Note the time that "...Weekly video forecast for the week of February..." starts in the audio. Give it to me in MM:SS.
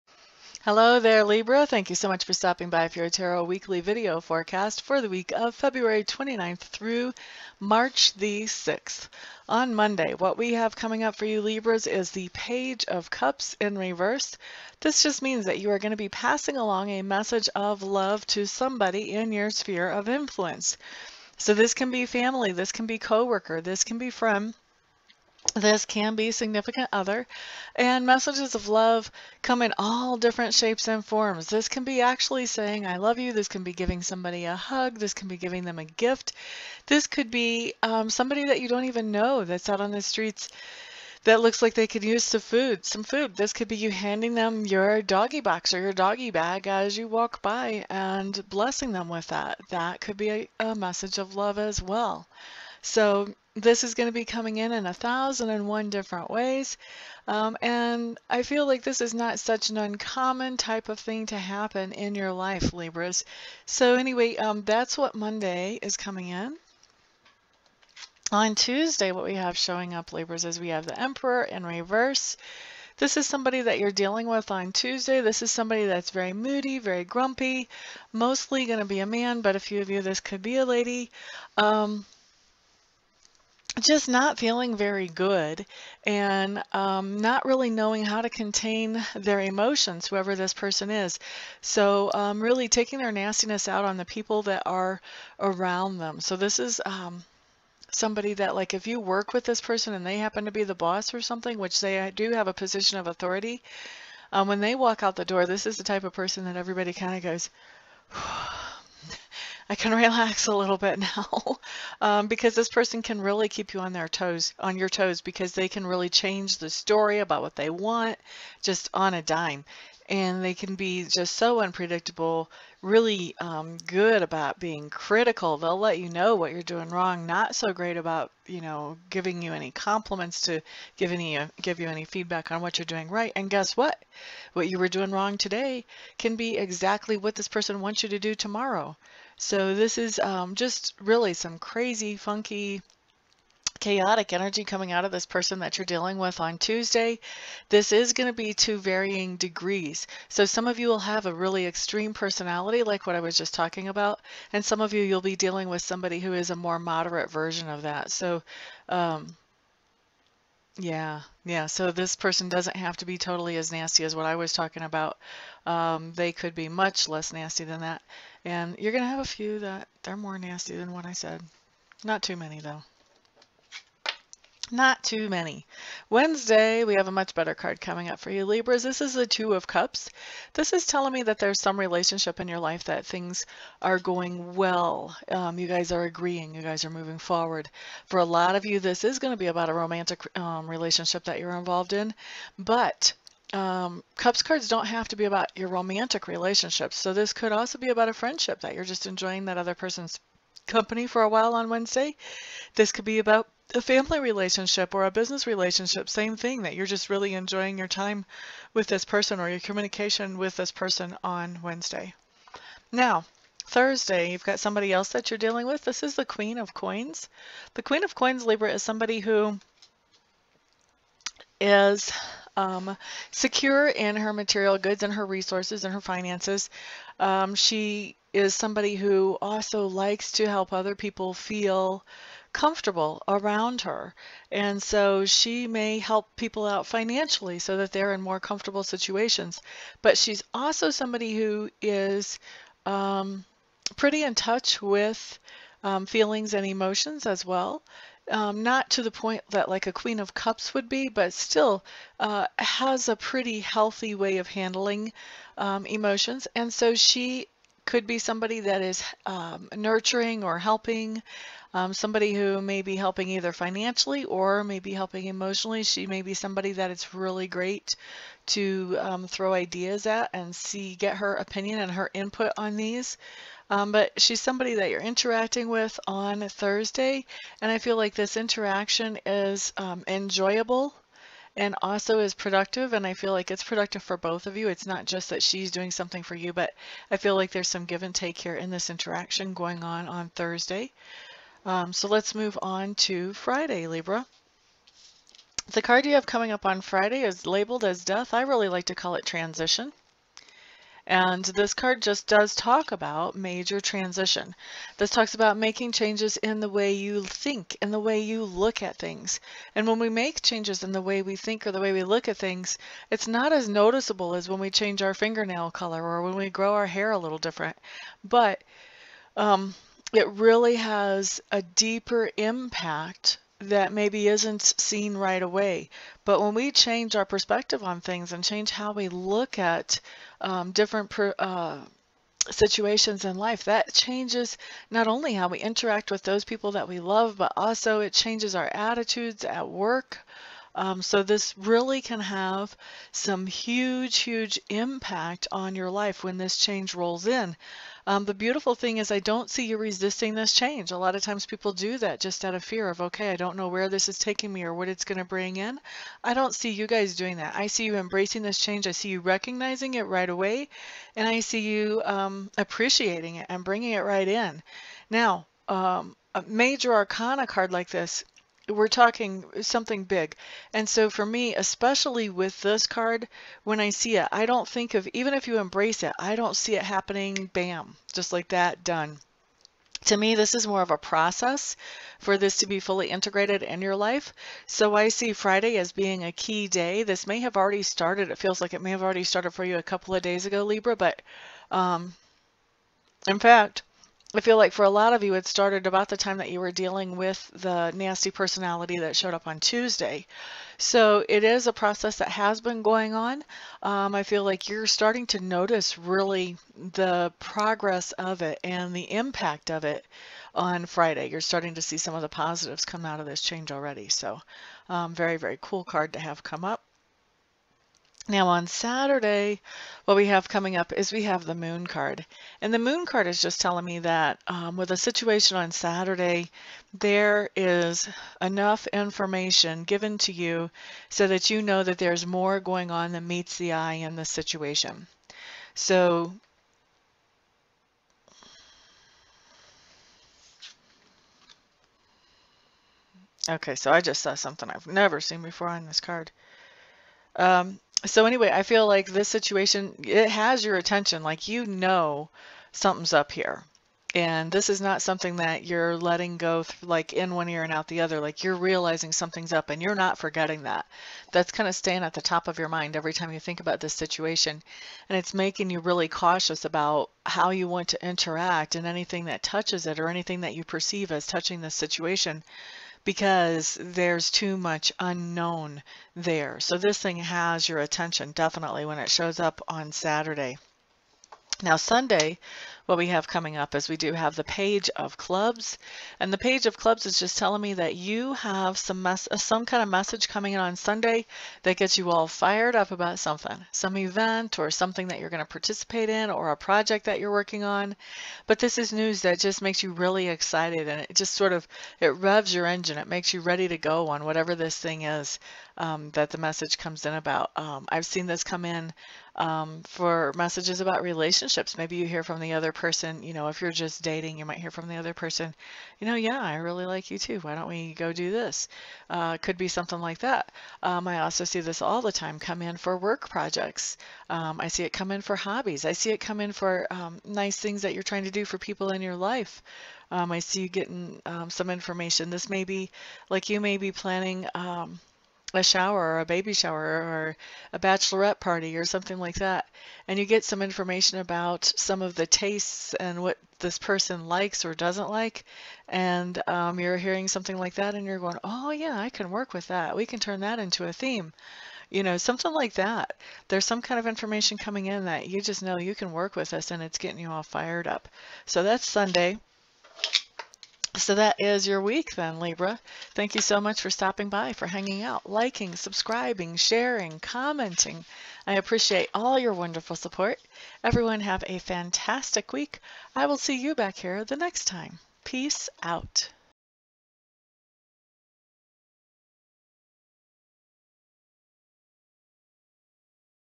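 00:03.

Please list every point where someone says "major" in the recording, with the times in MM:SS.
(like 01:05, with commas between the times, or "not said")
05:03, 06:06.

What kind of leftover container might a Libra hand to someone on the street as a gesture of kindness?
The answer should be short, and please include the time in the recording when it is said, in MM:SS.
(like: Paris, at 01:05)
doggy bag, at 00:45.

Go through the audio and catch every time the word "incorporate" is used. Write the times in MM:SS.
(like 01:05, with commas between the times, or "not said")
not said.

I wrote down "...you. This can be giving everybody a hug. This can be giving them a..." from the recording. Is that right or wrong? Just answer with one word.
wrong.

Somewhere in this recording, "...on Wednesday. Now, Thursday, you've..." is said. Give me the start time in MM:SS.
03:31.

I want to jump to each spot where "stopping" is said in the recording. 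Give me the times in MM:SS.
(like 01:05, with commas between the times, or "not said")
00:02, 09:23.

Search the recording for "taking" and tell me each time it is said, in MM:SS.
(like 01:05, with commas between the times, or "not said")
01:32, 05:54.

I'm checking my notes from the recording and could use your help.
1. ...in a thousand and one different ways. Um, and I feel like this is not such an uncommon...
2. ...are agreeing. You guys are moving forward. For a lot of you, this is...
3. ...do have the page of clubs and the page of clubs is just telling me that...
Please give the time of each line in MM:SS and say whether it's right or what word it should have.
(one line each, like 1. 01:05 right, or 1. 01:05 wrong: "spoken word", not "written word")
1. 00:54 right
2. 03:05 right
3. 08:03 right.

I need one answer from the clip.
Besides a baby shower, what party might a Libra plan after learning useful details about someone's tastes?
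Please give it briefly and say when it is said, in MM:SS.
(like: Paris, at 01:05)
bachelorette party, at 08:57.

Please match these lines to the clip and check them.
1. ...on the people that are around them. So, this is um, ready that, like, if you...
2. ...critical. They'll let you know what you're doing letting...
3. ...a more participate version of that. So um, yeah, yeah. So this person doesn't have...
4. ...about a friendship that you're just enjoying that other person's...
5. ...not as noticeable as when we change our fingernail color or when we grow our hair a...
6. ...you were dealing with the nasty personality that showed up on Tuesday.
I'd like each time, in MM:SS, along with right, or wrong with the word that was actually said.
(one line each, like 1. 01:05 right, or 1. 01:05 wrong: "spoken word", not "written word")
1. 01:33 wrong: "somebody", not "ready"
2. 02:04 wrong: "wrong", not "letting"
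3. 02:36 wrong: "moderate", not "participate"
4. 03:17 right
5. 05:13 right
6. 06:36 right.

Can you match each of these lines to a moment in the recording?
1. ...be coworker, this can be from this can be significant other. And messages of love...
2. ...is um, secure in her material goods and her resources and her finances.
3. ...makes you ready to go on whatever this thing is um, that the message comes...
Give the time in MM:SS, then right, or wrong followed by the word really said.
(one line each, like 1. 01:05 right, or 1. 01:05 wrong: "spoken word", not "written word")
1. 00:22 right
2. 03:41 right
3. 08:23 right.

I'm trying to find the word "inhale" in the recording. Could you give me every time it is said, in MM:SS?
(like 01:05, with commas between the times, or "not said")
not said.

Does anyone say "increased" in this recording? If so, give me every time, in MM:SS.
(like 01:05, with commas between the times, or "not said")
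not said.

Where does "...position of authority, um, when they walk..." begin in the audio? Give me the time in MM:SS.
01:42.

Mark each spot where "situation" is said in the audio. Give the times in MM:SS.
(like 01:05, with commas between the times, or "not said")
03:58, 05:32, 07:04, 07:14, 07:29, 07:43, 07:51.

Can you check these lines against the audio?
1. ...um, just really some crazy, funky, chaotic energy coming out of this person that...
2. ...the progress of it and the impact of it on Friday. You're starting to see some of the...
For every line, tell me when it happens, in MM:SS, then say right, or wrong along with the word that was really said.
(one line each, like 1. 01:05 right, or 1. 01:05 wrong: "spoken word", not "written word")
1. 02:20 right
2. 06:46 right.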